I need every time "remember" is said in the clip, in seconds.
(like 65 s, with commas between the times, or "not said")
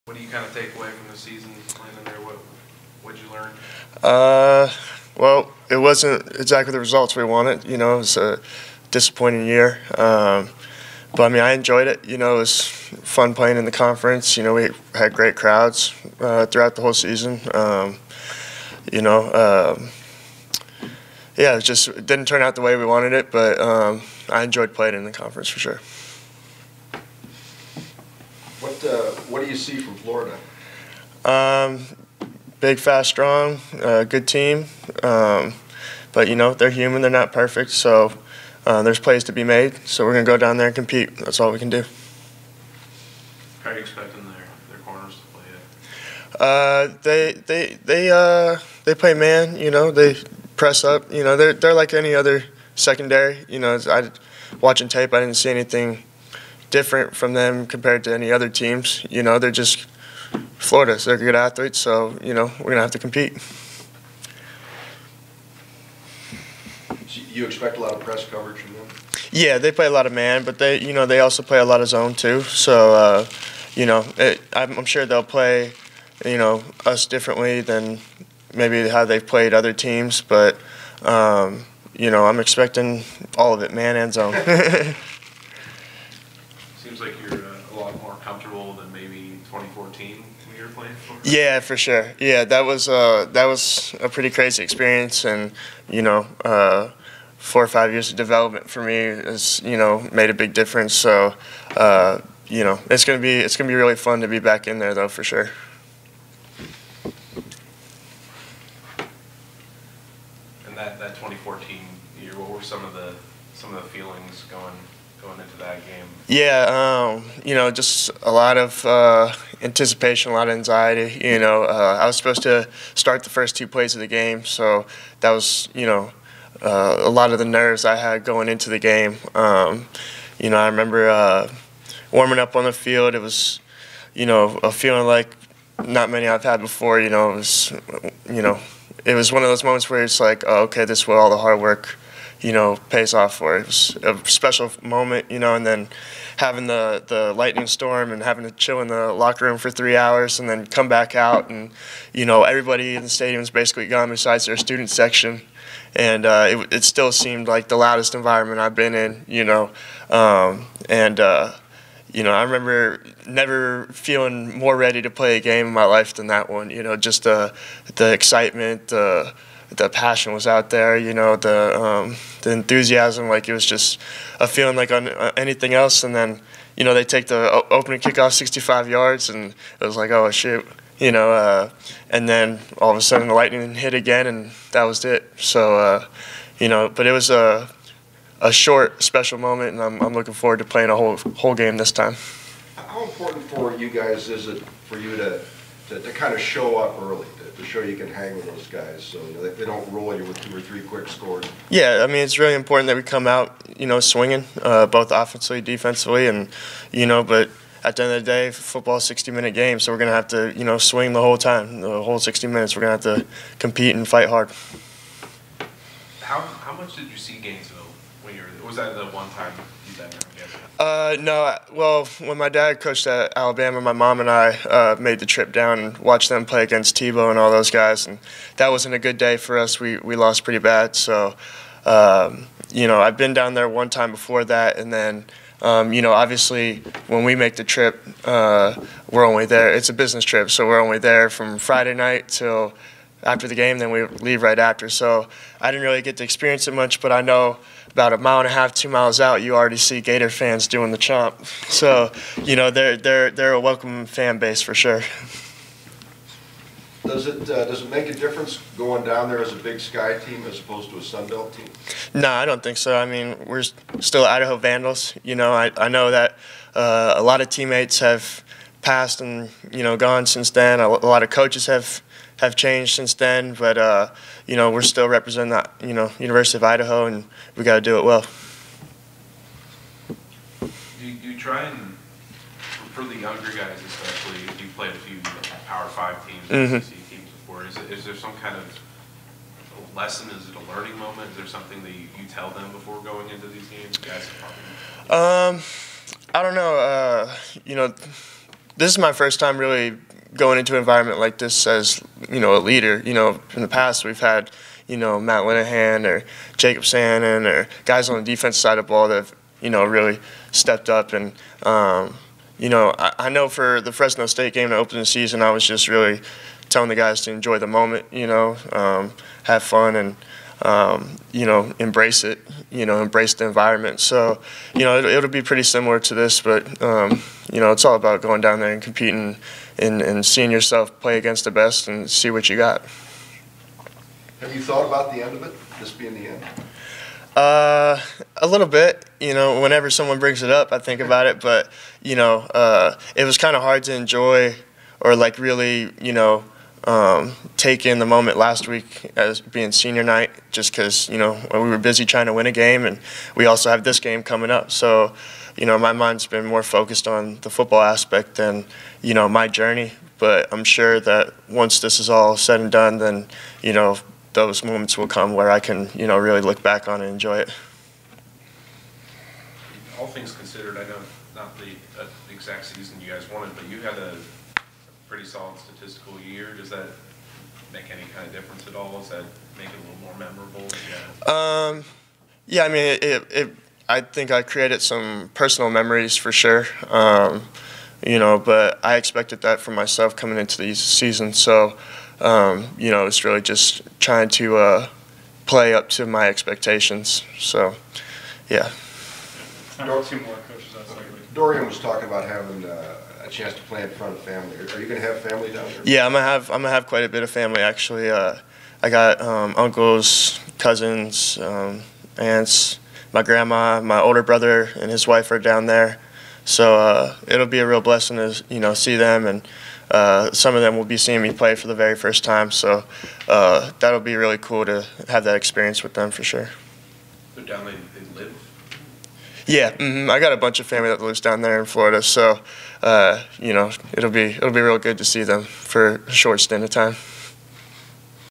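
130 s, 162 s.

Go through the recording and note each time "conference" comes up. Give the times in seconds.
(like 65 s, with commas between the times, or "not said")
13 s, 25 s.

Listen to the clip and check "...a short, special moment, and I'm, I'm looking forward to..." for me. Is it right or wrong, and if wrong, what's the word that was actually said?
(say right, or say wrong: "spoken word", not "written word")
right.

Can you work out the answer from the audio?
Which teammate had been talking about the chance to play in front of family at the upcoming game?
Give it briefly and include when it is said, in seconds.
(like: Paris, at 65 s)
Dorian, at 401 s.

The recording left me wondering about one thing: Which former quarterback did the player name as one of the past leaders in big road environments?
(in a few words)
Matt Linehan.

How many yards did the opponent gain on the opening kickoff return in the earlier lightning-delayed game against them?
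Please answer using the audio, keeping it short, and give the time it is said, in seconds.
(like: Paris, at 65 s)
65 yards, at 178 s.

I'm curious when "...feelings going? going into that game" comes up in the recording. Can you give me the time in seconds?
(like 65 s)
113 s.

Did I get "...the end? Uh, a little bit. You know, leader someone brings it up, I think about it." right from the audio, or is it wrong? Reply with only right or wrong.
wrong.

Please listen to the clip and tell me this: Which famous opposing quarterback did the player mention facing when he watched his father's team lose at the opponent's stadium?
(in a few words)
Tebow.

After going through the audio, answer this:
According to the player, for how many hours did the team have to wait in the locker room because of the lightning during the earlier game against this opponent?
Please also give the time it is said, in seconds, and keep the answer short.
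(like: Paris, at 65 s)
3 hours, at 149 s.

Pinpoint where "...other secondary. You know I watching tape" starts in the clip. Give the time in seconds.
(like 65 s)
52 s.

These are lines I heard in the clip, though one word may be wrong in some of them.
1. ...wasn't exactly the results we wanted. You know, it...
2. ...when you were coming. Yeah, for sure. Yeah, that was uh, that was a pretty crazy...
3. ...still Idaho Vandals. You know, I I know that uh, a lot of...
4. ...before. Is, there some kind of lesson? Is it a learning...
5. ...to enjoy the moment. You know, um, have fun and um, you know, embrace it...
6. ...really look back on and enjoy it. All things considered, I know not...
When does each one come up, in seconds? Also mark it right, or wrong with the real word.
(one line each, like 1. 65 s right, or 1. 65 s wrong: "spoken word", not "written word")
1. 5 s right
2. 90 s wrong: "playing", not "coming"
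3. 263 s right
4. 287 s right
5. 317 s right
6. 366 s right.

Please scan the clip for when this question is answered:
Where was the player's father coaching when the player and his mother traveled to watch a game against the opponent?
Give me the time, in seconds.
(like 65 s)
223 s.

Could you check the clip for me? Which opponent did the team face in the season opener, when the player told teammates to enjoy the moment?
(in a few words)
Fresno State.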